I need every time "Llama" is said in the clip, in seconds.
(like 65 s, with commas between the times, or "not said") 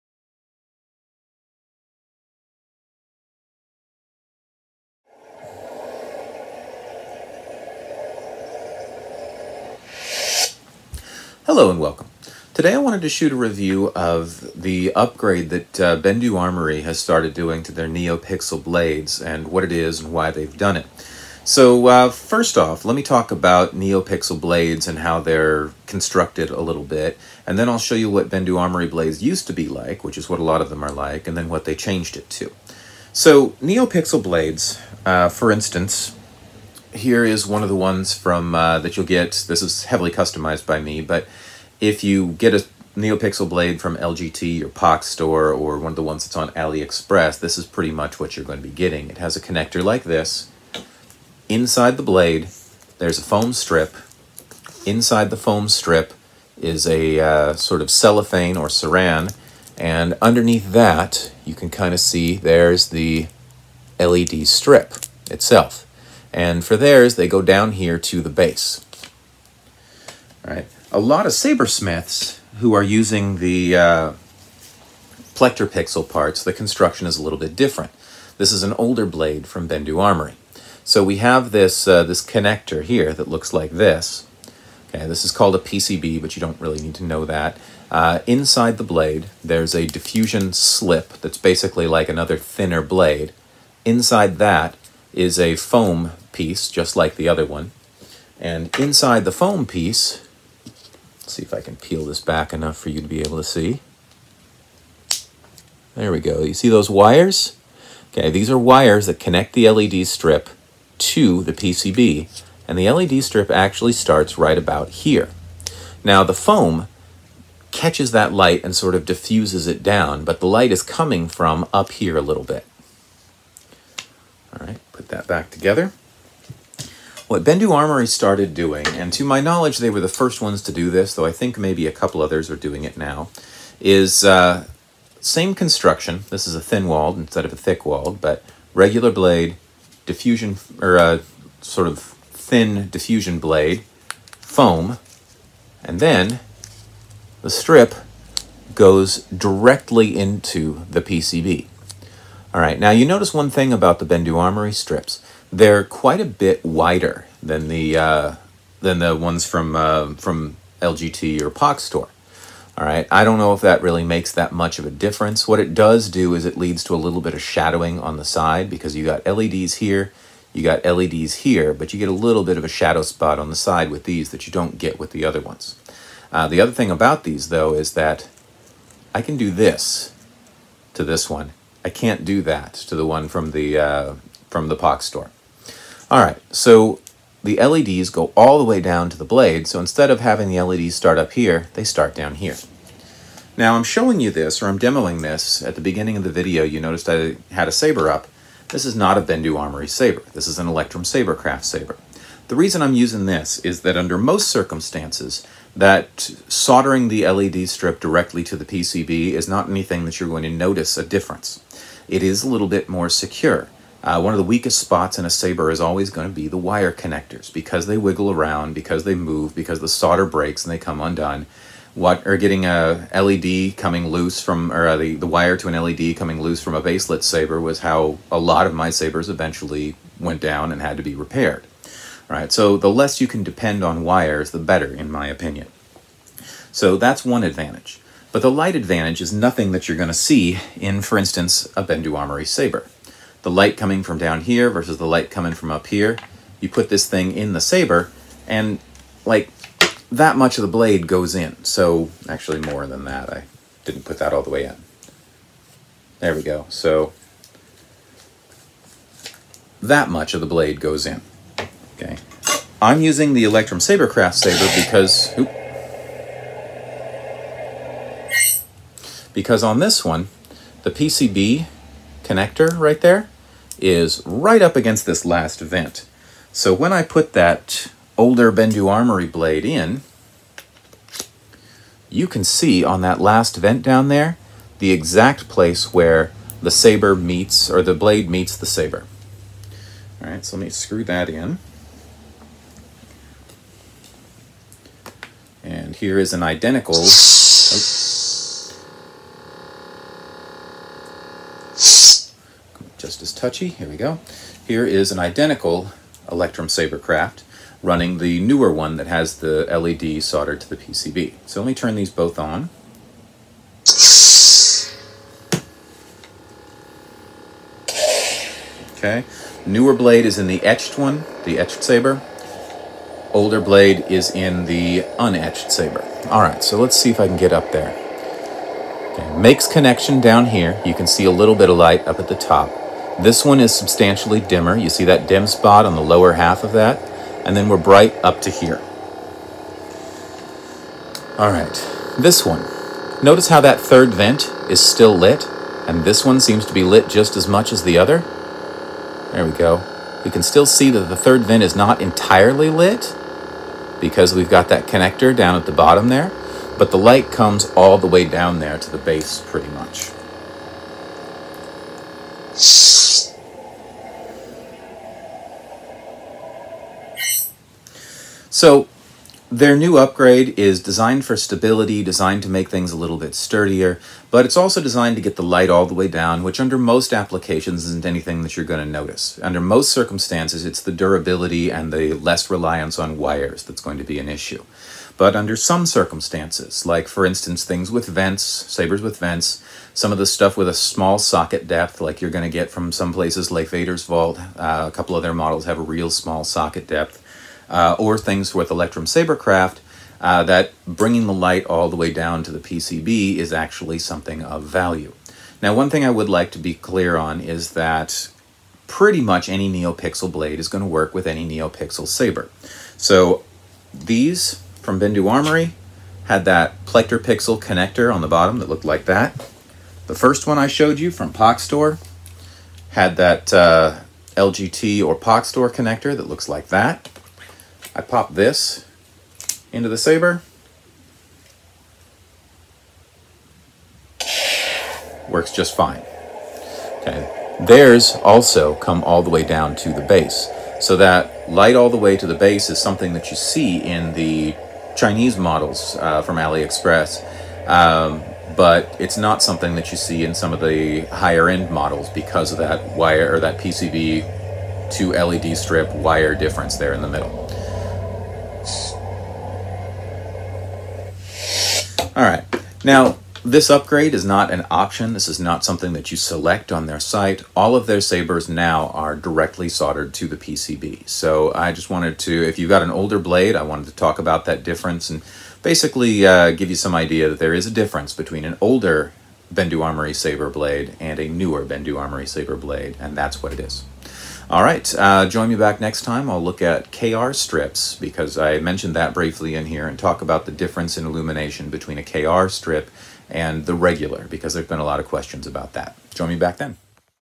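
not said.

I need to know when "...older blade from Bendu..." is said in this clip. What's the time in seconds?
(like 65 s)
78 s.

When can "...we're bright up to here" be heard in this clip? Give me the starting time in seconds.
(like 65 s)
337 s.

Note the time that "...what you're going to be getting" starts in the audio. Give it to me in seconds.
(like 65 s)
48 s.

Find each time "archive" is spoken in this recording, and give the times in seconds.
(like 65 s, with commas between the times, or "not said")
not said.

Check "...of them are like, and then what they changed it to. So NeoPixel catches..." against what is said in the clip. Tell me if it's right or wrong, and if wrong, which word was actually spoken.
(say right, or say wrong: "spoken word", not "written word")
wrong: "blades", not "catches".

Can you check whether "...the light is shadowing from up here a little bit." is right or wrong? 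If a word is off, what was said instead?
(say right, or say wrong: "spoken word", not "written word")
wrong: "coming", not "shadowing".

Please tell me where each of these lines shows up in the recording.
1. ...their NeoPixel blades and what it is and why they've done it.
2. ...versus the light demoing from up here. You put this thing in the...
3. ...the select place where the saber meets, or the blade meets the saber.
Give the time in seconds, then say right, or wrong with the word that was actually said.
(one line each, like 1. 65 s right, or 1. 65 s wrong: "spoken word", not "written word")
1. 17 s right
2. 244 s wrong: "coming", not "demoing"
3. 284 s wrong: "exact", not "select".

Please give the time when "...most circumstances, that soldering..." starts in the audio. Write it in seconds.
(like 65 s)
204 s.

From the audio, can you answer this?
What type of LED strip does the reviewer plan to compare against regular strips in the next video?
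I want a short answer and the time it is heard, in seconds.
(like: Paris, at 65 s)
KR strips, at 486 s.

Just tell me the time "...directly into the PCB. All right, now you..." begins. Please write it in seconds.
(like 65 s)
149 s.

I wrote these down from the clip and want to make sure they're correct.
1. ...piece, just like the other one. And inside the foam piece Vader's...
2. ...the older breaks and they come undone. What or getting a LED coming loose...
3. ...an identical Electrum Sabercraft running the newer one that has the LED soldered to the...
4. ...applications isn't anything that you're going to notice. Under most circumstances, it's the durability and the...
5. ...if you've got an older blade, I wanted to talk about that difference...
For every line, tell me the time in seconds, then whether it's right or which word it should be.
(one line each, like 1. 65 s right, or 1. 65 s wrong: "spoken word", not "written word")
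1. 96 s wrong: "Let", not "Vader"
2. 219 s wrong: "solder", not "older"
3. 305 s right
4. 377 s right
5. 472 s right.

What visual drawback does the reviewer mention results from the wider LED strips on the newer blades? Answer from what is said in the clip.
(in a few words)
shadowing on the side.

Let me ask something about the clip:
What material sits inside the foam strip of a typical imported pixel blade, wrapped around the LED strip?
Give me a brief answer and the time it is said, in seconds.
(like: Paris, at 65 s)
cellophane or saran, at 57 s.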